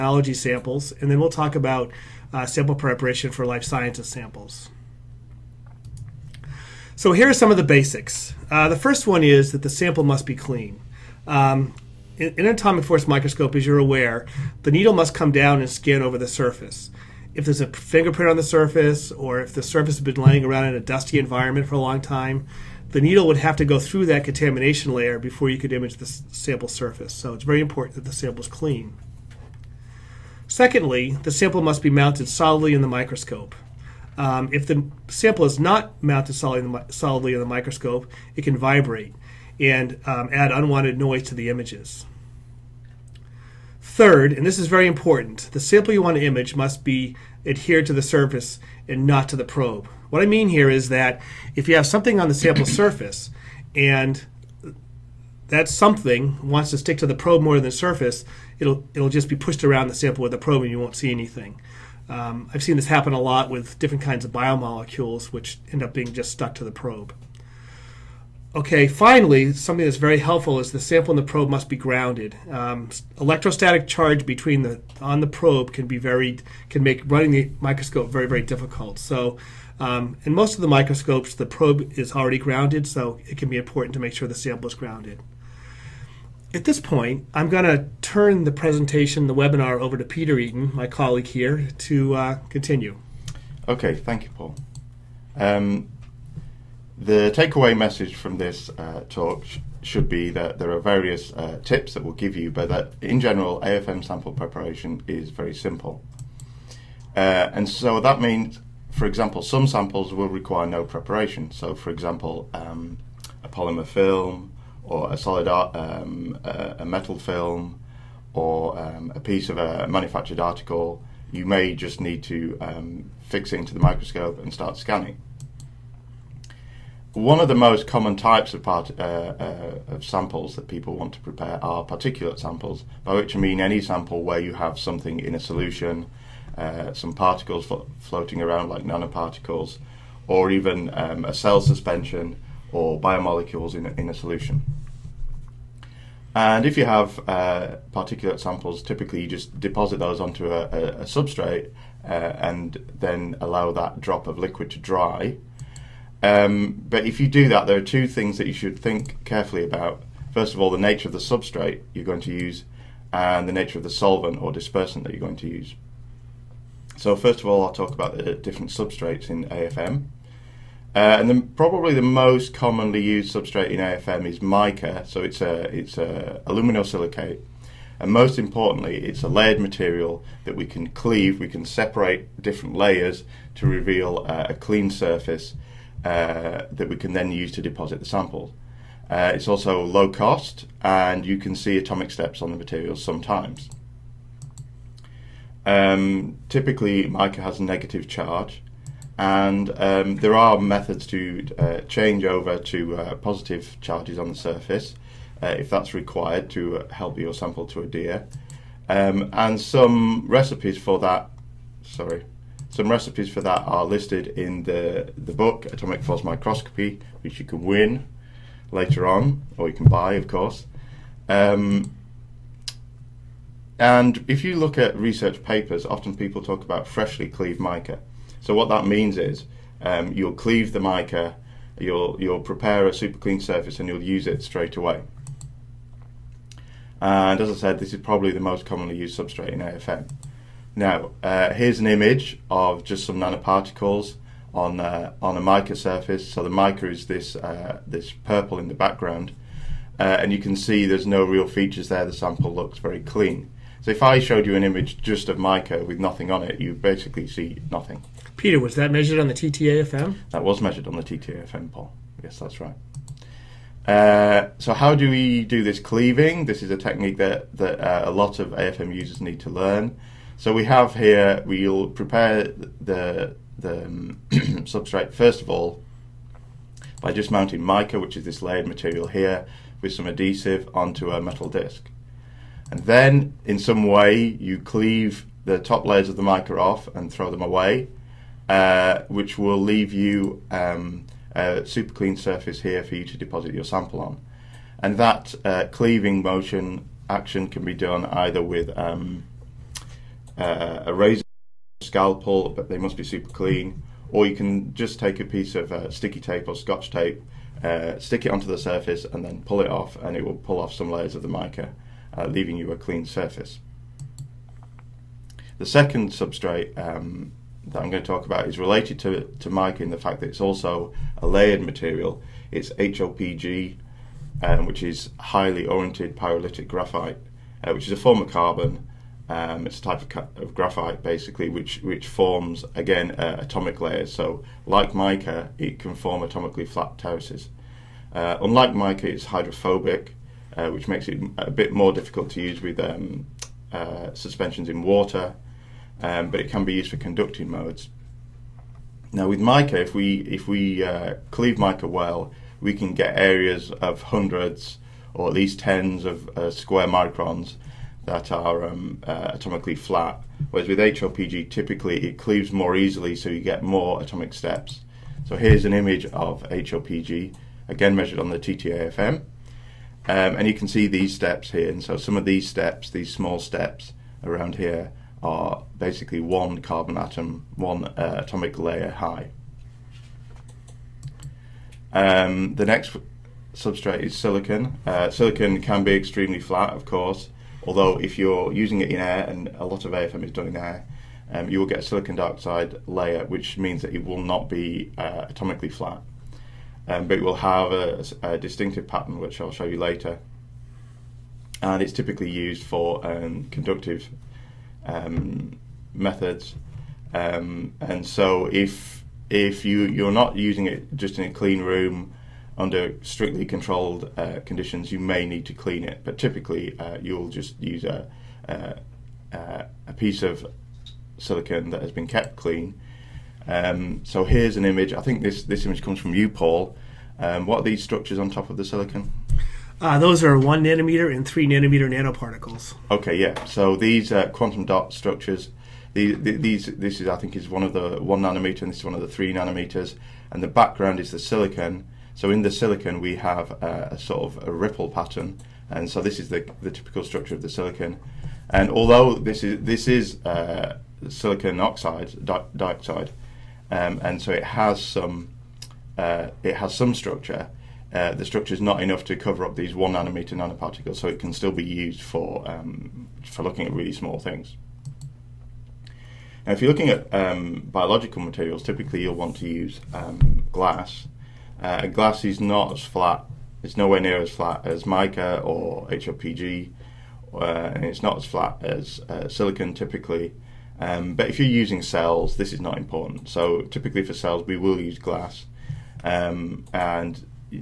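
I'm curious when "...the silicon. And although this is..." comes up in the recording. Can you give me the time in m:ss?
7:27.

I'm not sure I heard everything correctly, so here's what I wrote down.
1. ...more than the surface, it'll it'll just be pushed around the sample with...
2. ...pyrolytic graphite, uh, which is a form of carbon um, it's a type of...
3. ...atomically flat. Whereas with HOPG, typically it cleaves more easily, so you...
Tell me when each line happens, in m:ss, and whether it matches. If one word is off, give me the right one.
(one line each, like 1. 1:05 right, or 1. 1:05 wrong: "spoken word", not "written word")
1. 0:57 right
2. 5:26 right
3. 5:59 right.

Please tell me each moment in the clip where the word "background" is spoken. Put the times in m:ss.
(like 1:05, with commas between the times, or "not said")
4:08, 7:20.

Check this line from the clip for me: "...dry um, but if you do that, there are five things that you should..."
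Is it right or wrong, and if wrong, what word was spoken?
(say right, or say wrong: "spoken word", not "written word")
wrong: "two", not "five".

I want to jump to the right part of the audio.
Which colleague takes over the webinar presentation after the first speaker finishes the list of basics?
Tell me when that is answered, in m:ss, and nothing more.
1:30.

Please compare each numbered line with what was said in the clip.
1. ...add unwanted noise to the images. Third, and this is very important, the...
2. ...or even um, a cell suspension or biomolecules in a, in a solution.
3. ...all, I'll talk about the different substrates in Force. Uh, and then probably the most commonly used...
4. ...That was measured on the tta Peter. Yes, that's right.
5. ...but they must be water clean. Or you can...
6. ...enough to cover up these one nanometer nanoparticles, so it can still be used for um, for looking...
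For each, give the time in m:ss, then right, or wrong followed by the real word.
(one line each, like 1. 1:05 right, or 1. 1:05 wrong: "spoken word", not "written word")
1. 0:40 right
2. 2:20 right
3. 2:47 wrong: "AFM", not "Force"
4. 4:20 wrong: "Paul", not "Peter"
5. 5:02 wrong: "super", not "water"
6. 7:38 right.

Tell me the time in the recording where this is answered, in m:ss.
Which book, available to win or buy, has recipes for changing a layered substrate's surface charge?
3:35.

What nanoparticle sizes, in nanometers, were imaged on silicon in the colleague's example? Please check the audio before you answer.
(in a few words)
1 and 3 nanometers.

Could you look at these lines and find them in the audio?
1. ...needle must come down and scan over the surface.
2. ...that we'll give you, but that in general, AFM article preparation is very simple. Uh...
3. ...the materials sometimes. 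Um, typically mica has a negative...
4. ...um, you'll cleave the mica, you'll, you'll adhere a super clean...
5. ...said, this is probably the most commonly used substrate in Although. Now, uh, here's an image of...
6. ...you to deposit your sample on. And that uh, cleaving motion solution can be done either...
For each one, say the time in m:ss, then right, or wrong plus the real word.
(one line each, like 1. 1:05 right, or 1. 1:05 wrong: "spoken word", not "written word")
1. 0:14 right
2. 1:41 wrong: "sample", not "article"
3. 3:12 right
4. 3:49 wrong: "prepare", not "adhere"
5. 3:57 wrong: "AFM", not "Although"
6. 4:52 wrong: "action", not "solution".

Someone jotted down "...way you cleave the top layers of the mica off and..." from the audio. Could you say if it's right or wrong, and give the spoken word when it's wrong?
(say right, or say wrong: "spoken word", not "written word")
right.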